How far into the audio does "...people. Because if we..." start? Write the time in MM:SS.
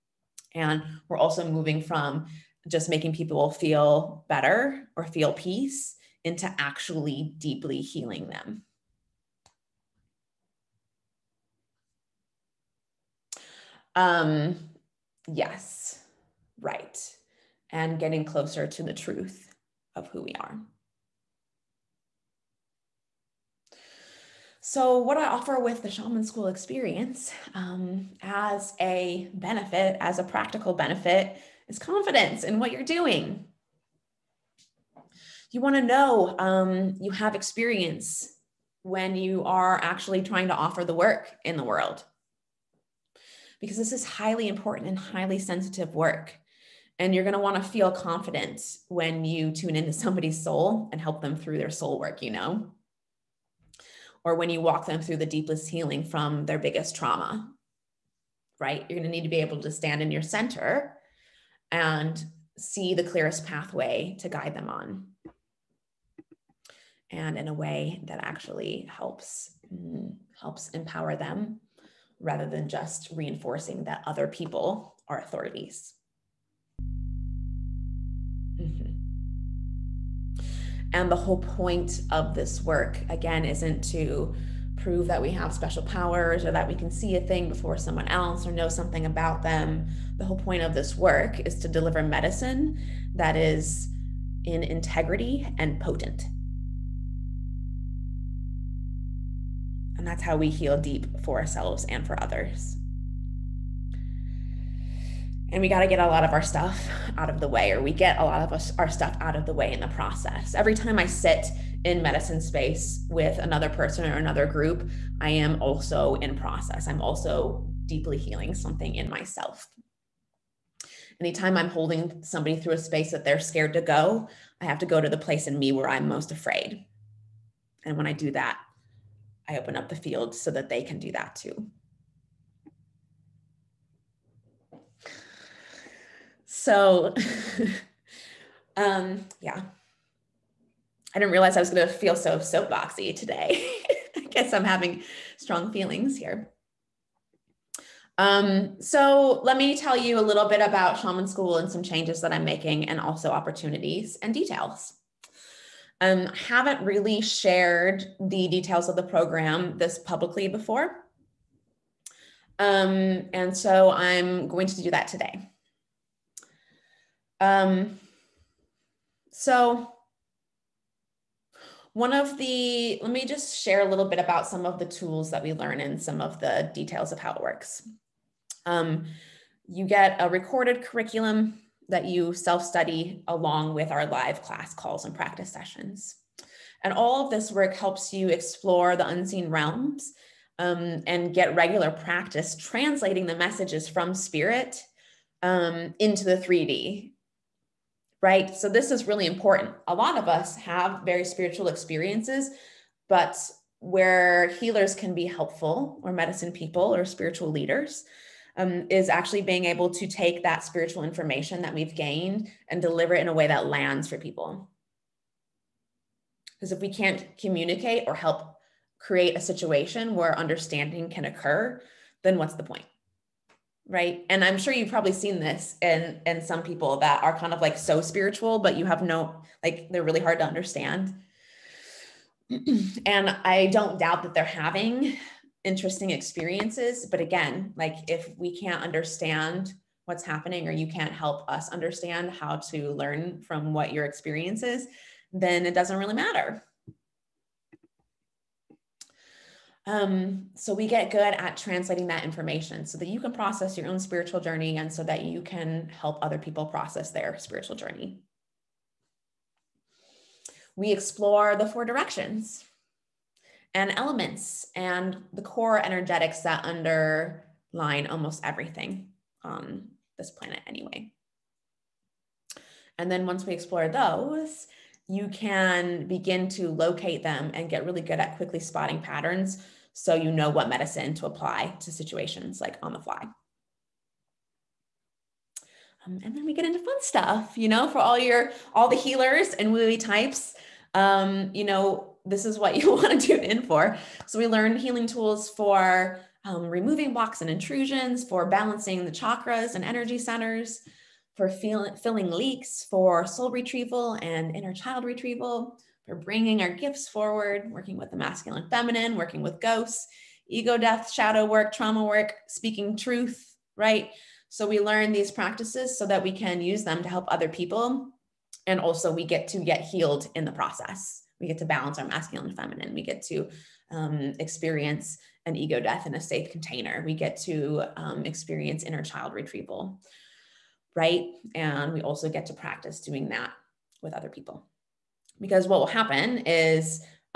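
03:34.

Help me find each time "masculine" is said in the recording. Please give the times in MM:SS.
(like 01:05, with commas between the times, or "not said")
05:08, 05:22.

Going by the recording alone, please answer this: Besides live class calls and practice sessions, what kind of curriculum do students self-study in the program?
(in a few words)
Recorded curriculum.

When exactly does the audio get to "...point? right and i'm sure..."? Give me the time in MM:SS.
03:42.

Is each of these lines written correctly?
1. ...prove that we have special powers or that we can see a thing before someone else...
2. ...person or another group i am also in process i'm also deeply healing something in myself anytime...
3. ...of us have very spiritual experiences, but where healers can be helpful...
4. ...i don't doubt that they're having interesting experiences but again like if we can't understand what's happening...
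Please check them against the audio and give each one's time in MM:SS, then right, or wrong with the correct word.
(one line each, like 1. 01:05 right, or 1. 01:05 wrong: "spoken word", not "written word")
1. 01:24 right
2. 01:53 right
3. 03:20 right
4. 03:53 right.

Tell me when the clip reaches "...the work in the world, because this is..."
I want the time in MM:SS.
00:40.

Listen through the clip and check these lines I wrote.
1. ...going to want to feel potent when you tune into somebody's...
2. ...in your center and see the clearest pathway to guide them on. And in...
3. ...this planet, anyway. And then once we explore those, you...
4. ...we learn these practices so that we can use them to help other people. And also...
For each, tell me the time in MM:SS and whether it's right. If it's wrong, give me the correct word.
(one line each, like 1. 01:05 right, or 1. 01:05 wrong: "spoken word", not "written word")
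1. 00:47 wrong: "confident", not "potent"
2. 01:00 right
3. 04:30 right
4. 05:14 right.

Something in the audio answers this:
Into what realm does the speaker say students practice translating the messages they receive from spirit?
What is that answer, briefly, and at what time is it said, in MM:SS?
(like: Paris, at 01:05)
The 3D, at 03:16.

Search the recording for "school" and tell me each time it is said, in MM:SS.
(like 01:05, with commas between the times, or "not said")
00:26, 02:31.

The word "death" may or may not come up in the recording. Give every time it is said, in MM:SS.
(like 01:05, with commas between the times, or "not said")
05:10, 05:25.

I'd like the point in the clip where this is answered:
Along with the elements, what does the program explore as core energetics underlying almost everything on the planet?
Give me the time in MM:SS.
04:21.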